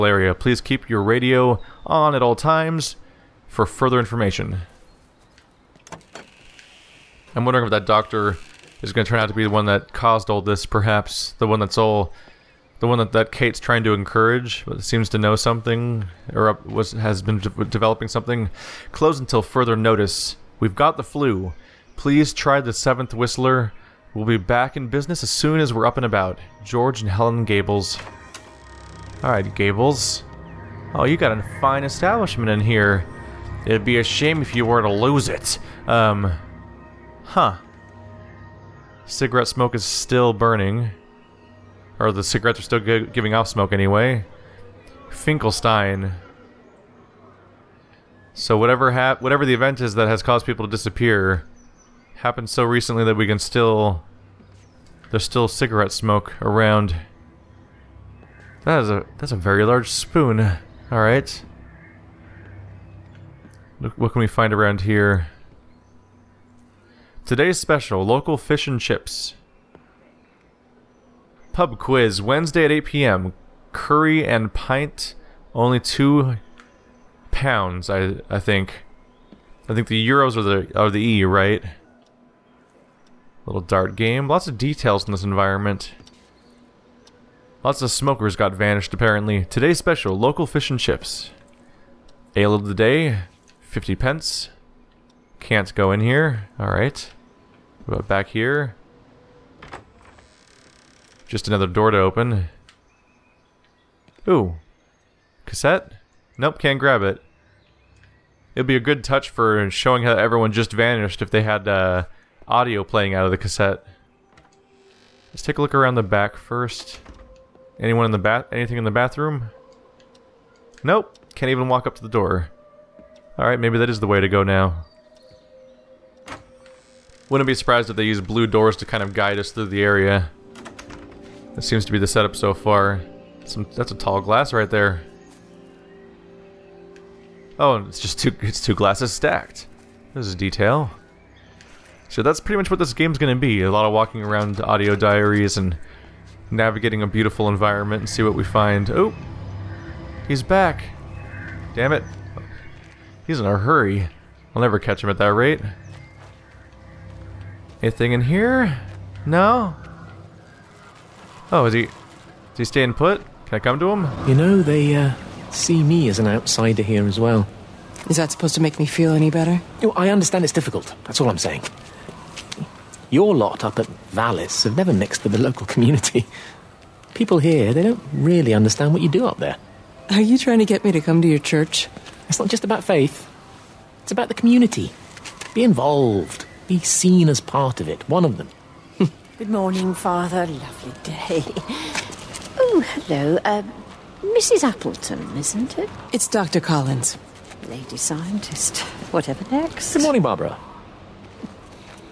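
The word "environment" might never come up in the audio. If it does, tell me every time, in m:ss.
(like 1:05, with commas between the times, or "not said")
1:25, 2:27.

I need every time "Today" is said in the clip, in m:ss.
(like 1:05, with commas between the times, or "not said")
1:07, 1:29.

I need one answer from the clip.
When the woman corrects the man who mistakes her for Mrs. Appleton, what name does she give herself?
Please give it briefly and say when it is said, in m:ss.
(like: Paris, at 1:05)
Dr. Collins, at 3:16.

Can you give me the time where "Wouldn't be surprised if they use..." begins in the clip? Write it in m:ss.
2:07.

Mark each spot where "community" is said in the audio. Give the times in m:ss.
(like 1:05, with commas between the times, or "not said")
2:55, 3:04.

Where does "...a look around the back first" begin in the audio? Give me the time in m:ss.
1:55.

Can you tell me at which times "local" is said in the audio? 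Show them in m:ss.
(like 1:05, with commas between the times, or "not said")
1:08, 1:30, 2:55.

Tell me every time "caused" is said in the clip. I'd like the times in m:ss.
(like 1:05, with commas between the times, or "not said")
0:09, 0:50.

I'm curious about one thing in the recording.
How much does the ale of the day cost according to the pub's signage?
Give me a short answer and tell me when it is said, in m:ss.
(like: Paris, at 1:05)
50 pence, at 1:33.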